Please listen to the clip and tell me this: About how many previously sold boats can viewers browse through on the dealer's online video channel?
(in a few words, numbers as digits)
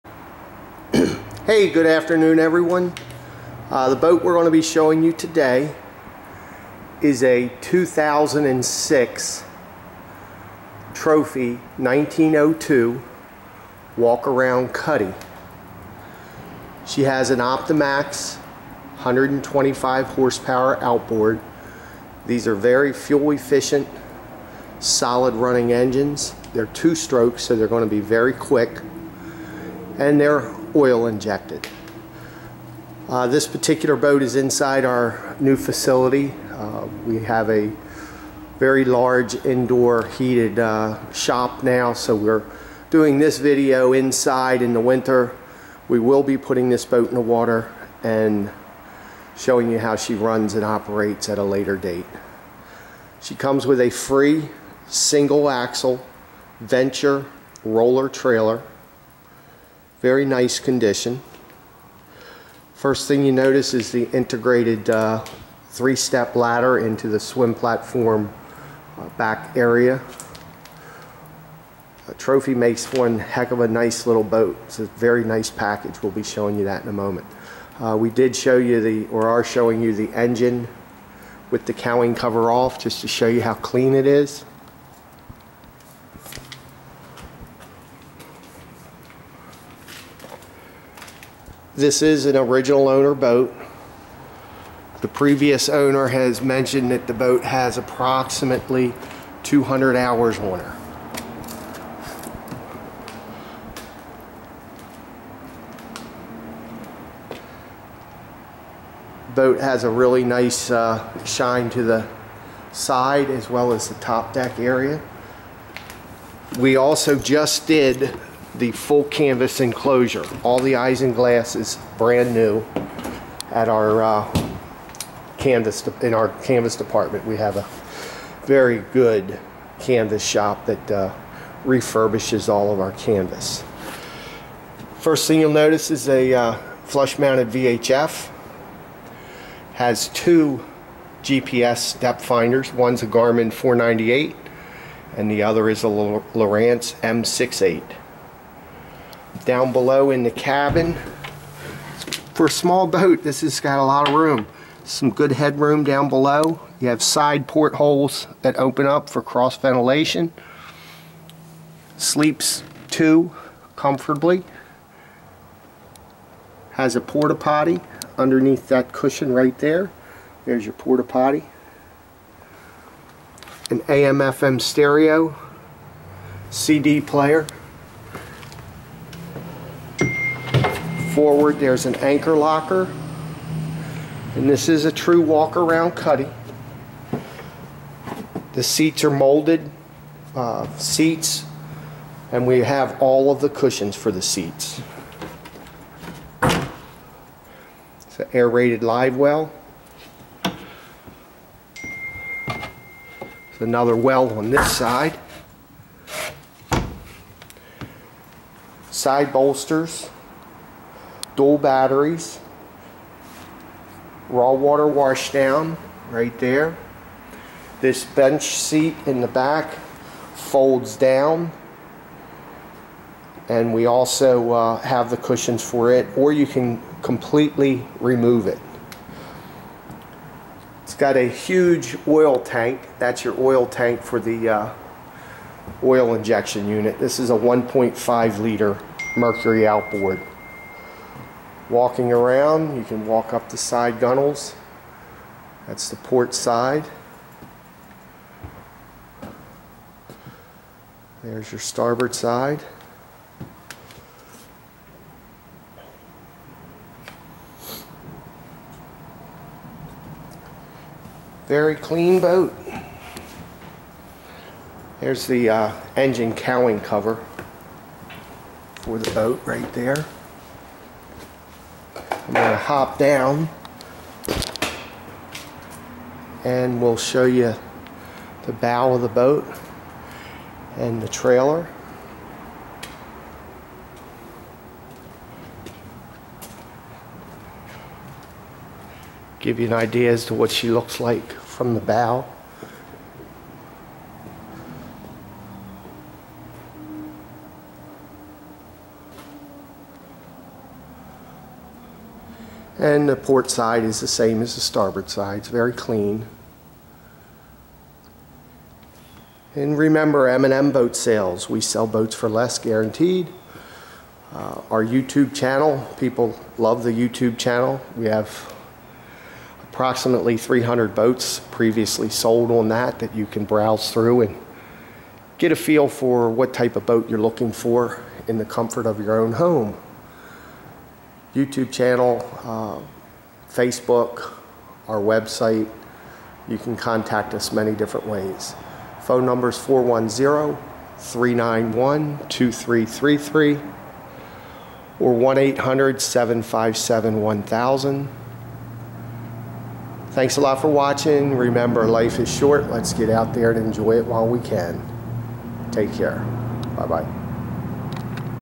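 300.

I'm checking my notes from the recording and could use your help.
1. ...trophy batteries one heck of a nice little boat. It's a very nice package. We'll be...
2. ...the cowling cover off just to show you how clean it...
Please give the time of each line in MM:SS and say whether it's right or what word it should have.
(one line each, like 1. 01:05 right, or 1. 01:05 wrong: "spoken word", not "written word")
1. 01:12 wrong: "makes", not "batteries"
2. 01:21 right.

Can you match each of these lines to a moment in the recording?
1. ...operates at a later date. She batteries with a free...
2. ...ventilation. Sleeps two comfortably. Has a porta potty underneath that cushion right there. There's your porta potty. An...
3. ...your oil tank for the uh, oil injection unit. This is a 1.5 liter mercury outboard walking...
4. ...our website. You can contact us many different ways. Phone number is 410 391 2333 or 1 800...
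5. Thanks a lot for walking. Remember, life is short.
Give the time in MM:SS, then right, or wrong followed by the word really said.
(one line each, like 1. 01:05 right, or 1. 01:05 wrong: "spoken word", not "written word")
1. 00:50 wrong: "comes", not "batteries"
2. 02:39 right
3. 03:53 right
4. 05:34 right
5. 05:50 wrong: "watching", not "walking".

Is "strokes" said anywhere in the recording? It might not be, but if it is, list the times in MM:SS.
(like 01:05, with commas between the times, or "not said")
00:26.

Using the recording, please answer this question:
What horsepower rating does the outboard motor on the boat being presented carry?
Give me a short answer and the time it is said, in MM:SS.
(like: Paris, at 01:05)
125, at 00:18.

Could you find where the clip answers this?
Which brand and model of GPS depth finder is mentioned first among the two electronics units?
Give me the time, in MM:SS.
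02:23.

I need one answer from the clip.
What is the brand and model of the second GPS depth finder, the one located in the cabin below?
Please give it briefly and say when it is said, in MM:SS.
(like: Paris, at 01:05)
Lowrance M68, at 02:25.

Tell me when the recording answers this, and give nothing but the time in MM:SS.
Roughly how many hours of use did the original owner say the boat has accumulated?
01:39.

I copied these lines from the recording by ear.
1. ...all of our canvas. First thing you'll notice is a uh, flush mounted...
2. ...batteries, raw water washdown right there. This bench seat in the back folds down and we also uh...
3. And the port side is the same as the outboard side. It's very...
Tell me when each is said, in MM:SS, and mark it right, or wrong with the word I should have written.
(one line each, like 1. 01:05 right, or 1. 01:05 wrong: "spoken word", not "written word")
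1. 02:12 right
2. 03:31 right
3. 05:02 wrong: "starboard", not "outboard".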